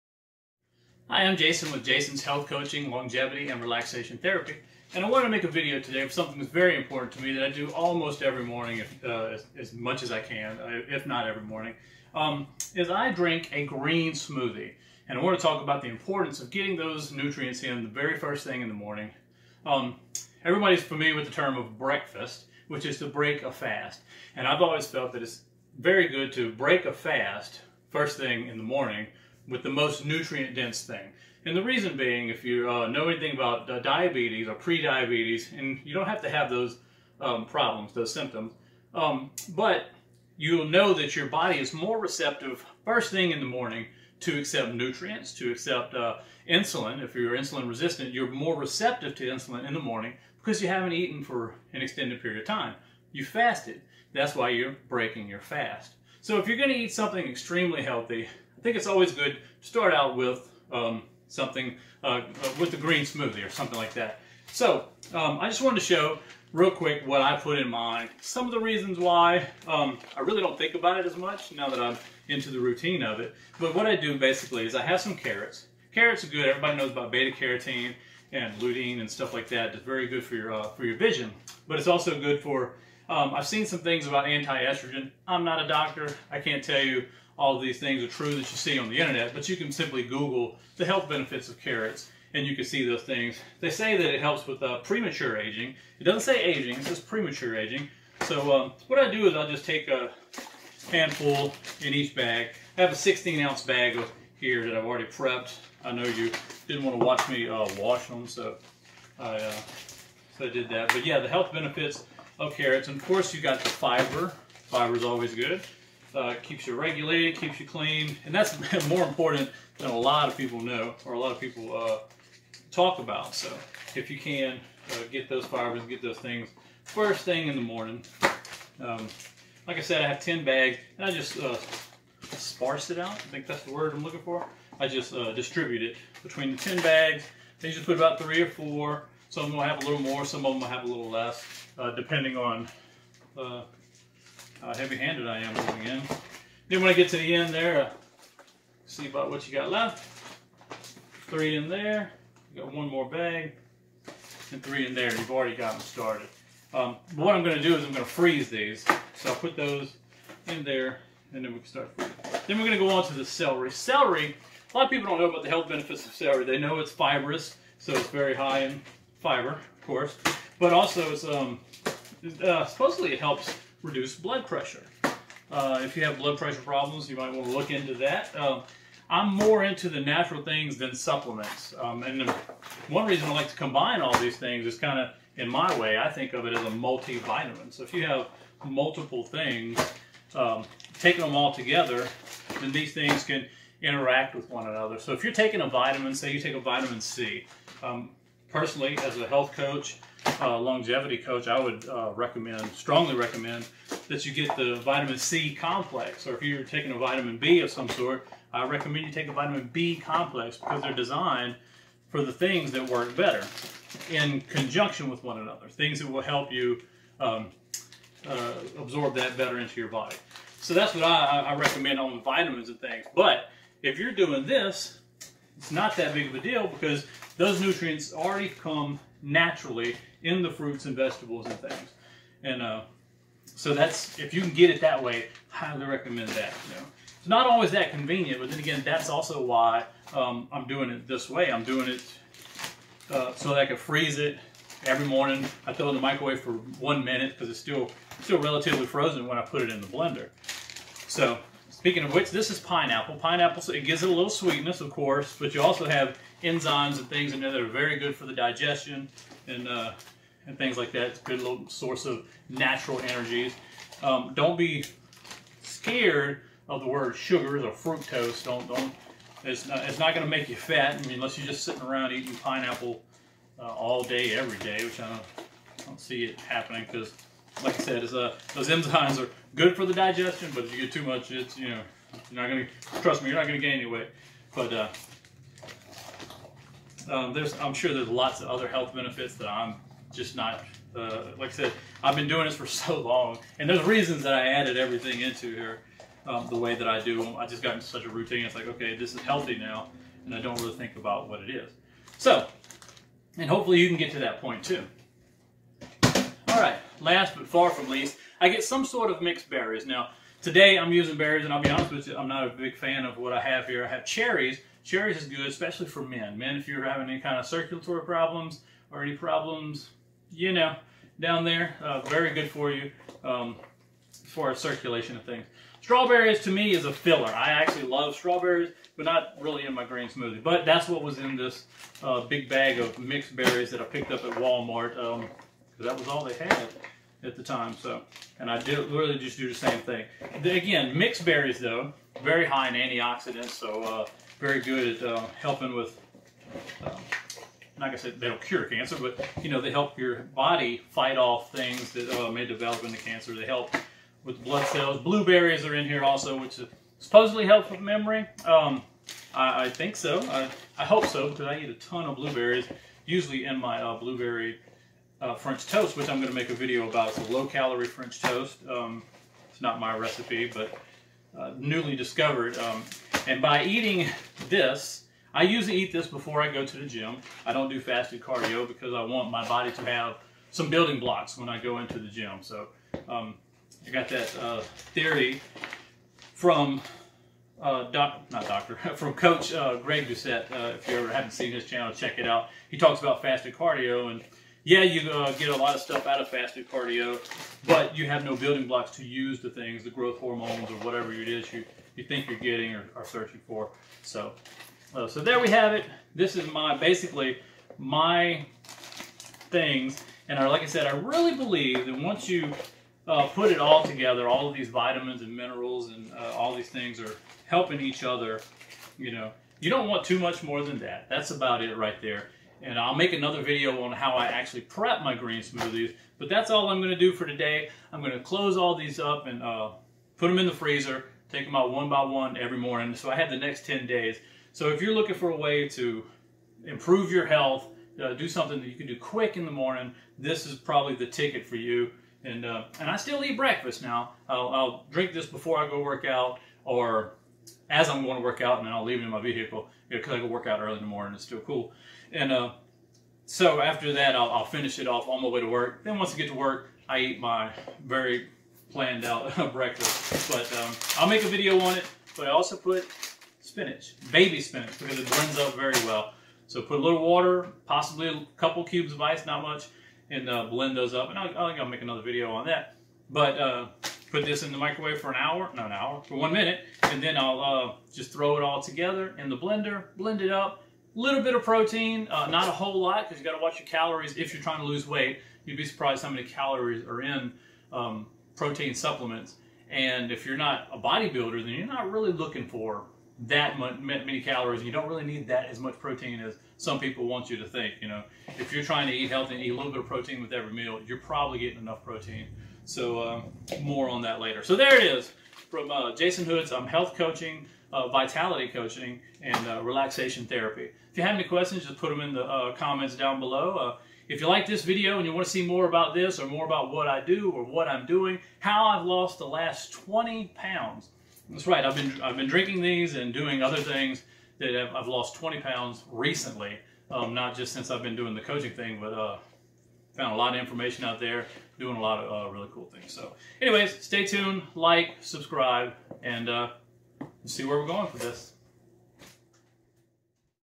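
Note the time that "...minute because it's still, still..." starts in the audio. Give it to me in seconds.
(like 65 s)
247 s.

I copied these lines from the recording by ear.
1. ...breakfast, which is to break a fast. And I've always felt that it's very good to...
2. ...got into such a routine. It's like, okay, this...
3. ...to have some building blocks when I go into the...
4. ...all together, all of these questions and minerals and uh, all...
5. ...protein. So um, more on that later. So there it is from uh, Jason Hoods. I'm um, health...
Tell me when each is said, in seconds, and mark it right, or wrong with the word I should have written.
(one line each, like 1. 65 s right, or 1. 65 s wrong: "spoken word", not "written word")
1. 21 s right
2. 297 s right
3. 379 s right
4. 413 s wrong: "vitamins", not "questions"
5. 501 s right.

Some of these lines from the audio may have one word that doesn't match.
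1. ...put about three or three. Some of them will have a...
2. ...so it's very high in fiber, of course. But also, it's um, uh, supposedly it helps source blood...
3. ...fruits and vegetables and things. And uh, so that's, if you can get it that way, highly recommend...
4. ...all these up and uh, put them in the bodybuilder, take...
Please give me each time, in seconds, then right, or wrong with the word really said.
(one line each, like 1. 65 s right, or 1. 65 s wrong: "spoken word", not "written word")
1. 137 s wrong: "four", not "three"
2. 167 s wrong: "reduce", not "source"
3. 230 s right
4. 428 s wrong: "freezer", not "bodybuilder".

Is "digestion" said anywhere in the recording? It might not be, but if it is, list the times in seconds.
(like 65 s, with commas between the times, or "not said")
258 s, 279 s.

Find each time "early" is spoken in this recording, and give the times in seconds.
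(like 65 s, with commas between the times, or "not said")
450 s.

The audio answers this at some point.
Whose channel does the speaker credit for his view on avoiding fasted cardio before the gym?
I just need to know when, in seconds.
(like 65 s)
389 s.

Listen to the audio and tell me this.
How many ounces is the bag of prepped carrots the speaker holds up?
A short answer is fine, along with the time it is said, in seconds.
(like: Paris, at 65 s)
16 ounce, at 102 s.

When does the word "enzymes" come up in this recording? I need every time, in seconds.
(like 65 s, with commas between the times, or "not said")
256 s, 278 s.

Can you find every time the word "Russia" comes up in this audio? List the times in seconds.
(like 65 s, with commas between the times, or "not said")
not said.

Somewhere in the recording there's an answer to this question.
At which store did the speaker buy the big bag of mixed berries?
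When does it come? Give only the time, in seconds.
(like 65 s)
334 s.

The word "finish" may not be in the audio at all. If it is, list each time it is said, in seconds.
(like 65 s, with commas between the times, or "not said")
454 s.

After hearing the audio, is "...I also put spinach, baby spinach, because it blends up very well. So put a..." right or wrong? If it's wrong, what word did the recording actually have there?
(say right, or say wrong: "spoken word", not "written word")
right.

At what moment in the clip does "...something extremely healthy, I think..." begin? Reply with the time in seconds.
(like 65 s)
56 s.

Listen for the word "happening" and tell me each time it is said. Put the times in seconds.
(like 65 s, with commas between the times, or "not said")
276 s.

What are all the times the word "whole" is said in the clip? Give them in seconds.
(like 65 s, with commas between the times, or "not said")
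482 s.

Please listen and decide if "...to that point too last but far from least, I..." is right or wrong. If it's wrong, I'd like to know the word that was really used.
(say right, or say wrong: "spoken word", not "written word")
right.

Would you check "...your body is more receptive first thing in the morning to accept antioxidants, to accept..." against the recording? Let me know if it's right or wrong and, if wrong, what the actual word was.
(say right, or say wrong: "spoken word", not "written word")
wrong: "nutrients", not "antioxidants".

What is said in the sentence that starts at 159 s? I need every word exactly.
So I'll put those in there, and then we can start Then we're going to go on to the celery.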